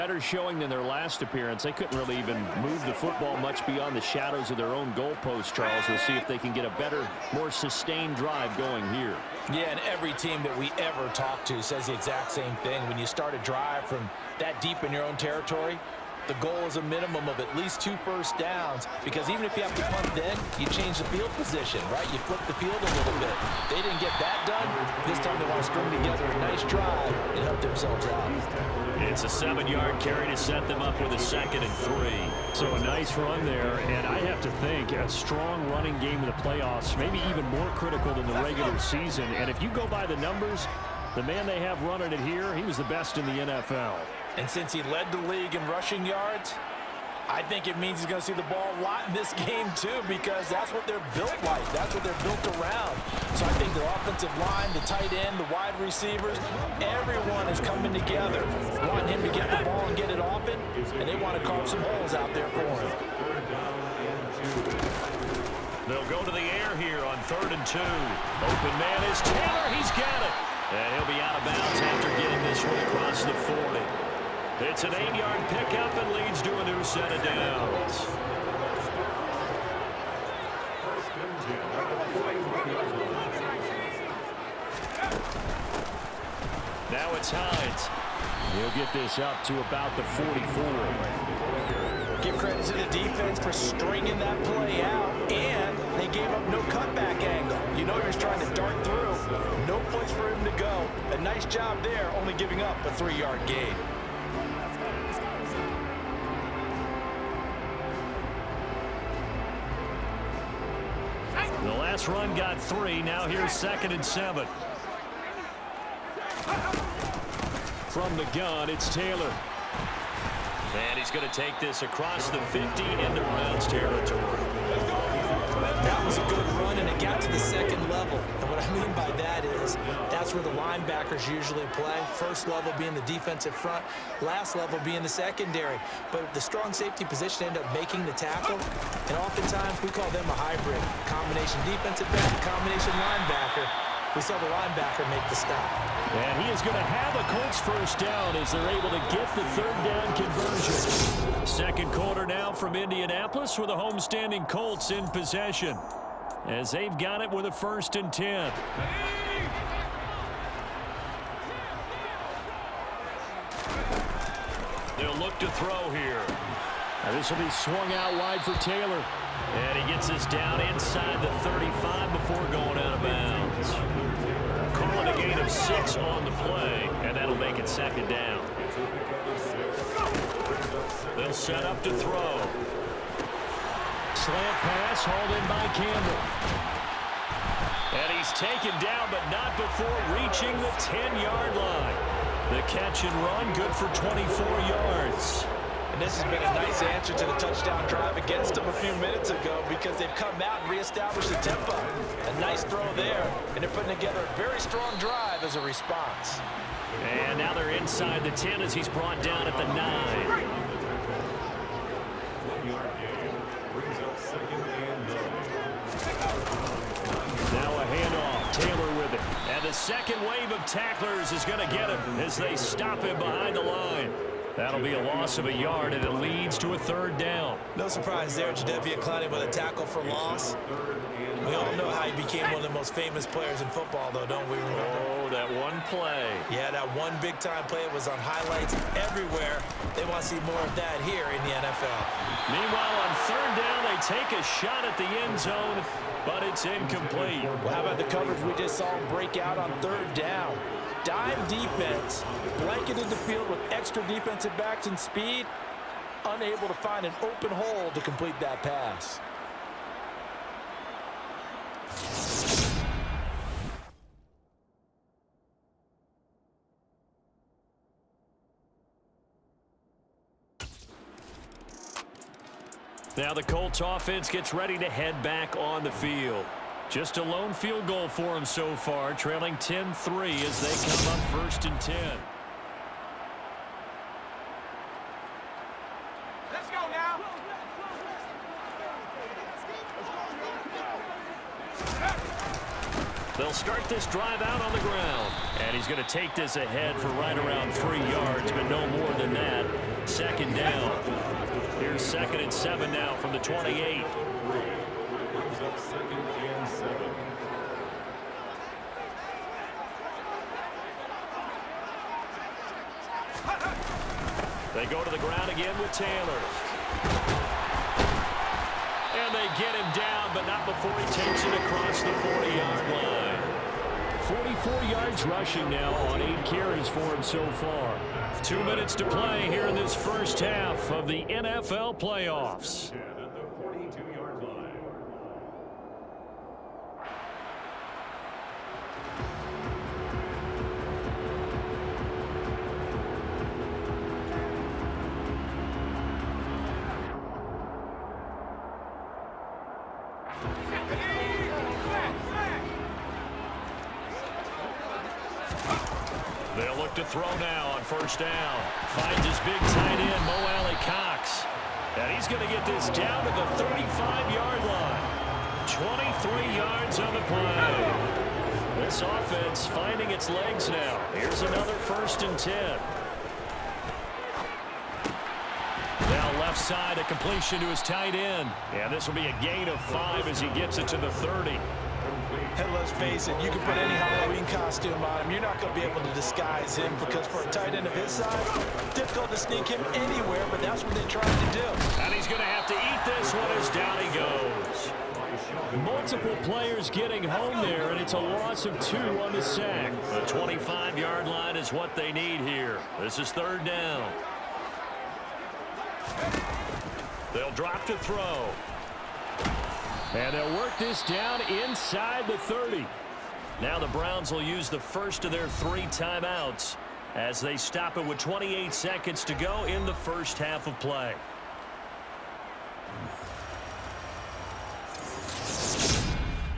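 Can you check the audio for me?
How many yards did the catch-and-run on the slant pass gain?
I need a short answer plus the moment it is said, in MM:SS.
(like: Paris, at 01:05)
24, at 03:13.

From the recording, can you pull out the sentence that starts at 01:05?
They'll go to the air here on third and two.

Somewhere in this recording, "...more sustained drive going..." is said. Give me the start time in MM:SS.
00:07.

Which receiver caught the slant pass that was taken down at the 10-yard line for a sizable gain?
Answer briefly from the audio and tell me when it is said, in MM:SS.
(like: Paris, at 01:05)
Campbell, at 03:05.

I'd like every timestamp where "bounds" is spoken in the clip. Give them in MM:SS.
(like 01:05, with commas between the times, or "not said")
01:11, 02:53.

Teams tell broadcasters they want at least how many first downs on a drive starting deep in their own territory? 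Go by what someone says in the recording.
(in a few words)
2.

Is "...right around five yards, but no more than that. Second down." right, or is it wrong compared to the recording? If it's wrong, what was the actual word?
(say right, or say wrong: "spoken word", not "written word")
wrong: "three", not "five".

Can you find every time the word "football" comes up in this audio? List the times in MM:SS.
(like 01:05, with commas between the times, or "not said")
00:02, 03:53.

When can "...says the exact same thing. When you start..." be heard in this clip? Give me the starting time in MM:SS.
00:11.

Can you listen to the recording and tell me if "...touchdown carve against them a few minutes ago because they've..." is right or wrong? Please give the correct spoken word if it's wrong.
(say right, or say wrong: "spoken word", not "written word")
wrong: "drive", not "carve".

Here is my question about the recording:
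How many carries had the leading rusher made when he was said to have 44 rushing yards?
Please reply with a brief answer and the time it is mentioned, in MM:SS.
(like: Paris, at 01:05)
8, at 05:26.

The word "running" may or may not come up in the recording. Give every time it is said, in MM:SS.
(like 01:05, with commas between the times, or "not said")
00:35, 00:41.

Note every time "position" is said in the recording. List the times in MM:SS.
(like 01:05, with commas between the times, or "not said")
00:21, 02:17.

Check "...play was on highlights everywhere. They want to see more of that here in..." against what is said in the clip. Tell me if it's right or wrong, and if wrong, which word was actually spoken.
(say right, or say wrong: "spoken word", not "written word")
right.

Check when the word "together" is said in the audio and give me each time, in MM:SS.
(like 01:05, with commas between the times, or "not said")
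00:25, 00:57, 03:23.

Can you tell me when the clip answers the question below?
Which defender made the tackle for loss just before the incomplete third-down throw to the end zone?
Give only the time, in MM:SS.
03:48.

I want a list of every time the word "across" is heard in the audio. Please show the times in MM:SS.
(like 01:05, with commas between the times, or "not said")
01:12, 02:01, 05:21.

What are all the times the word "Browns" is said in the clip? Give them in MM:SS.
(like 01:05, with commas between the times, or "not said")
02:03, 06:53.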